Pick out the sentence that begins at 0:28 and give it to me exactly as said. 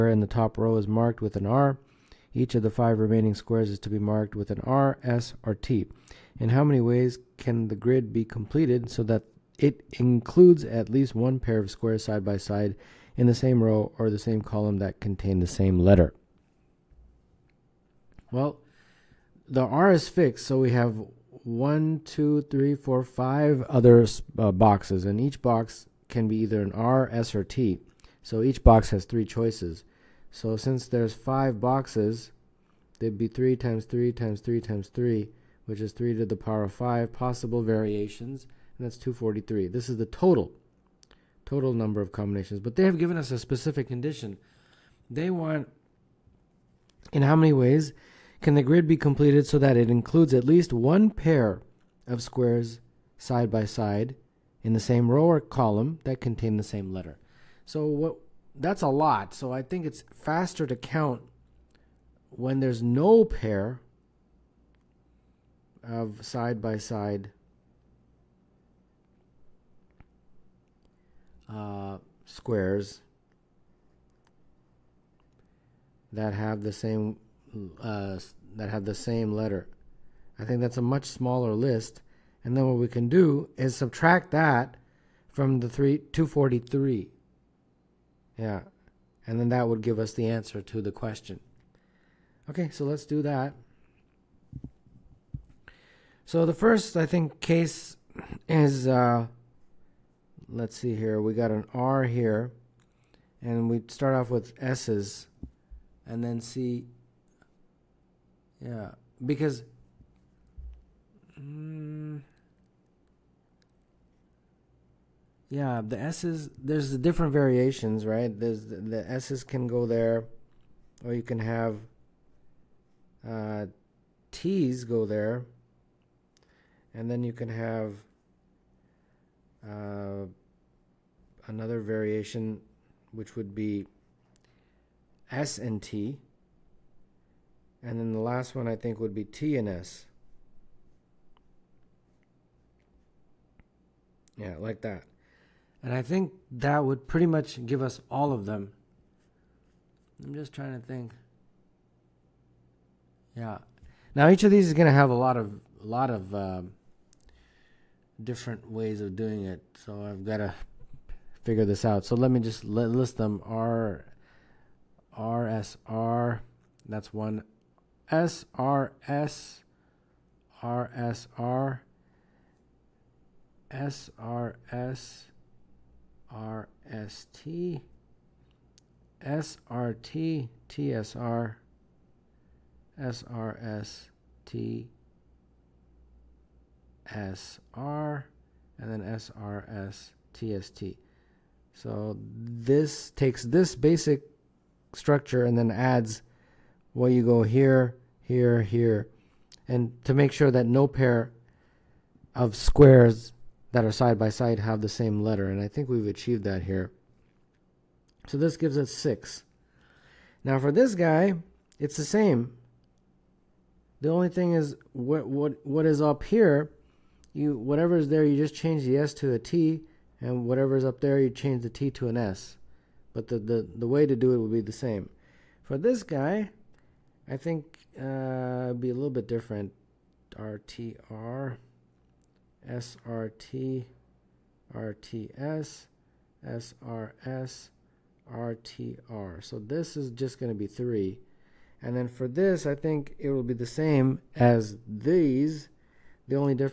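So each box has three choices.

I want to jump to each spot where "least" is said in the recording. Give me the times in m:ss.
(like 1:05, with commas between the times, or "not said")
0:10, 0:50.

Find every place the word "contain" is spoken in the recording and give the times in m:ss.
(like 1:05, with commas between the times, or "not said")
0:14, 0:56.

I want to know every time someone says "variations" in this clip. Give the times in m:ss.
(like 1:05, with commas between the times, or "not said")
0:37, 1:57, 2:11.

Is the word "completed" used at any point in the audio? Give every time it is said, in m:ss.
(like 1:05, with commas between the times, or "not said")
0:08, 0:48.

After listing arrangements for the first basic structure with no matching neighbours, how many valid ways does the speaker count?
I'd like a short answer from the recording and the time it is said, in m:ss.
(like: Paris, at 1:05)
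6, at 3:28.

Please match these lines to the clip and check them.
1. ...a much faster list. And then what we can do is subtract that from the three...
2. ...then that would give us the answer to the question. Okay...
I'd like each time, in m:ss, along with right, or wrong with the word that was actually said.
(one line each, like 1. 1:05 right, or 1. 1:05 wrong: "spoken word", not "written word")
1. 1:20 wrong: "smaller", not "faster"
2. 1:29 right.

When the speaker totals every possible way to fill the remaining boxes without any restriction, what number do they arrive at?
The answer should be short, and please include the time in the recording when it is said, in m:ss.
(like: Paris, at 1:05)
243, at 0:38.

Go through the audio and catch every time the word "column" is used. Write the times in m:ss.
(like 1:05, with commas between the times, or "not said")
0:14, 0:55.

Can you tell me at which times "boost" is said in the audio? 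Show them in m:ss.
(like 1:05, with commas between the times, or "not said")
not said.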